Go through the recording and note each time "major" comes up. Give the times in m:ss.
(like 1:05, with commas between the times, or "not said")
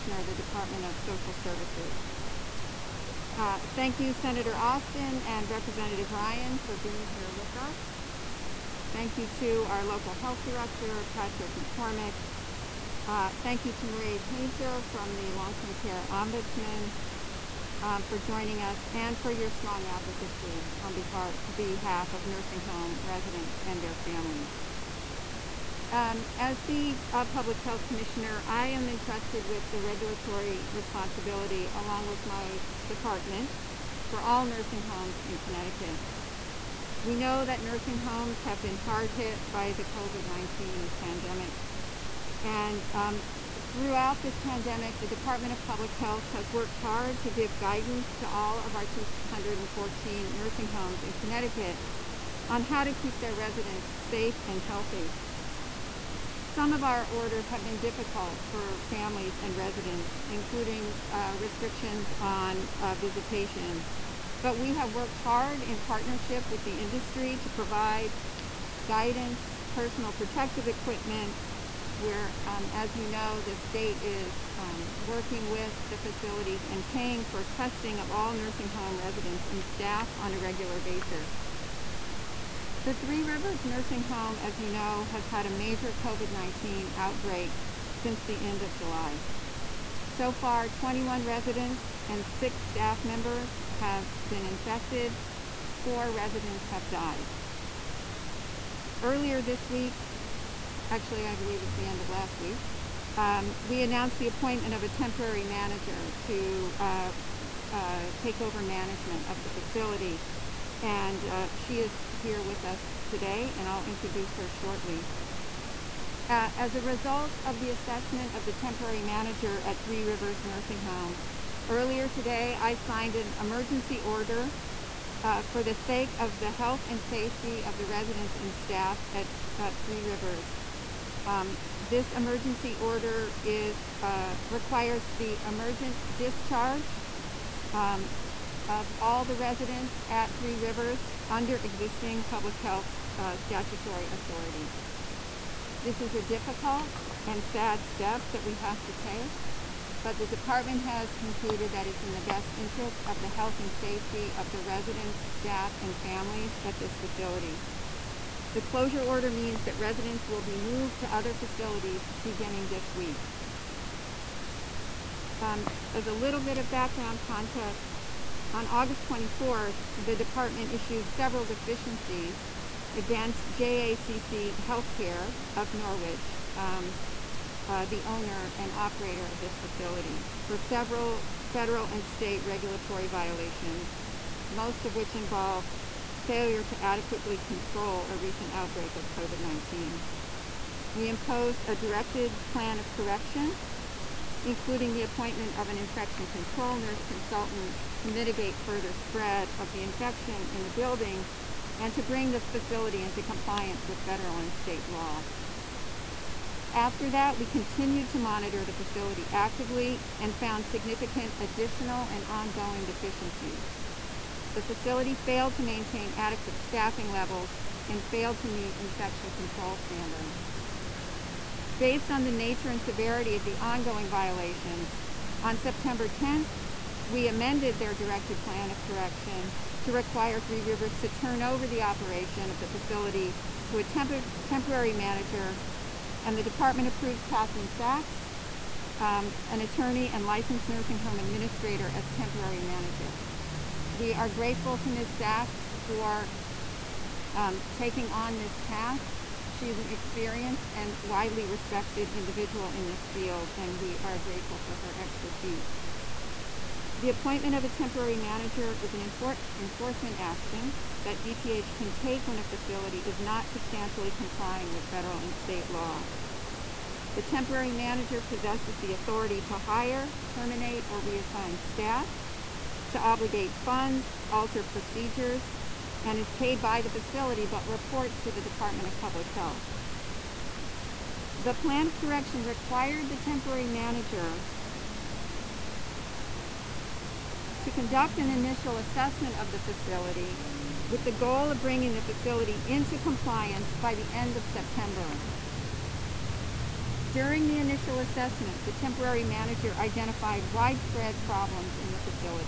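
1:25.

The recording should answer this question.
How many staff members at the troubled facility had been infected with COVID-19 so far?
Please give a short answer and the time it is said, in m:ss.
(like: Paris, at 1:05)
6, at 1:32.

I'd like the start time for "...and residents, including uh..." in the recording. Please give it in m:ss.
0:59.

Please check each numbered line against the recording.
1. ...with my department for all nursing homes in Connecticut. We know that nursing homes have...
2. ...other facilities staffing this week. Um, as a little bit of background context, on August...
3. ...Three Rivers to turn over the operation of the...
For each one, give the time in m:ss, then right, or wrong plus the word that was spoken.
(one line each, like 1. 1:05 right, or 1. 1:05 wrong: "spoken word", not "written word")
1. 0:32 right
2. 2:41 wrong: "beginning", not "staffing"
3. 3:50 right.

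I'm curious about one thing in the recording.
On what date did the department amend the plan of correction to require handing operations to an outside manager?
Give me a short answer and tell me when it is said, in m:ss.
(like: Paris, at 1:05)
September 10th, at 3:45.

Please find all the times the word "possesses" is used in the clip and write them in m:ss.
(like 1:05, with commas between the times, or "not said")
4:28.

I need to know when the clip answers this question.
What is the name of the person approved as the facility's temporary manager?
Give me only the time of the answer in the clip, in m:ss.
3:57.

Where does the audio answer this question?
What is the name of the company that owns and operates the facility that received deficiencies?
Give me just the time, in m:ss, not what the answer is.
2:53.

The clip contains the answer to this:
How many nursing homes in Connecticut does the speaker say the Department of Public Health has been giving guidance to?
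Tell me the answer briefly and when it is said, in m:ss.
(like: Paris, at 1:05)
214, at 0:48.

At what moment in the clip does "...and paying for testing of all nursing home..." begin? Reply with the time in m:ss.
1:16.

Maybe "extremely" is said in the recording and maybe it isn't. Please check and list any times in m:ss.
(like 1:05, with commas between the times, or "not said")
not said.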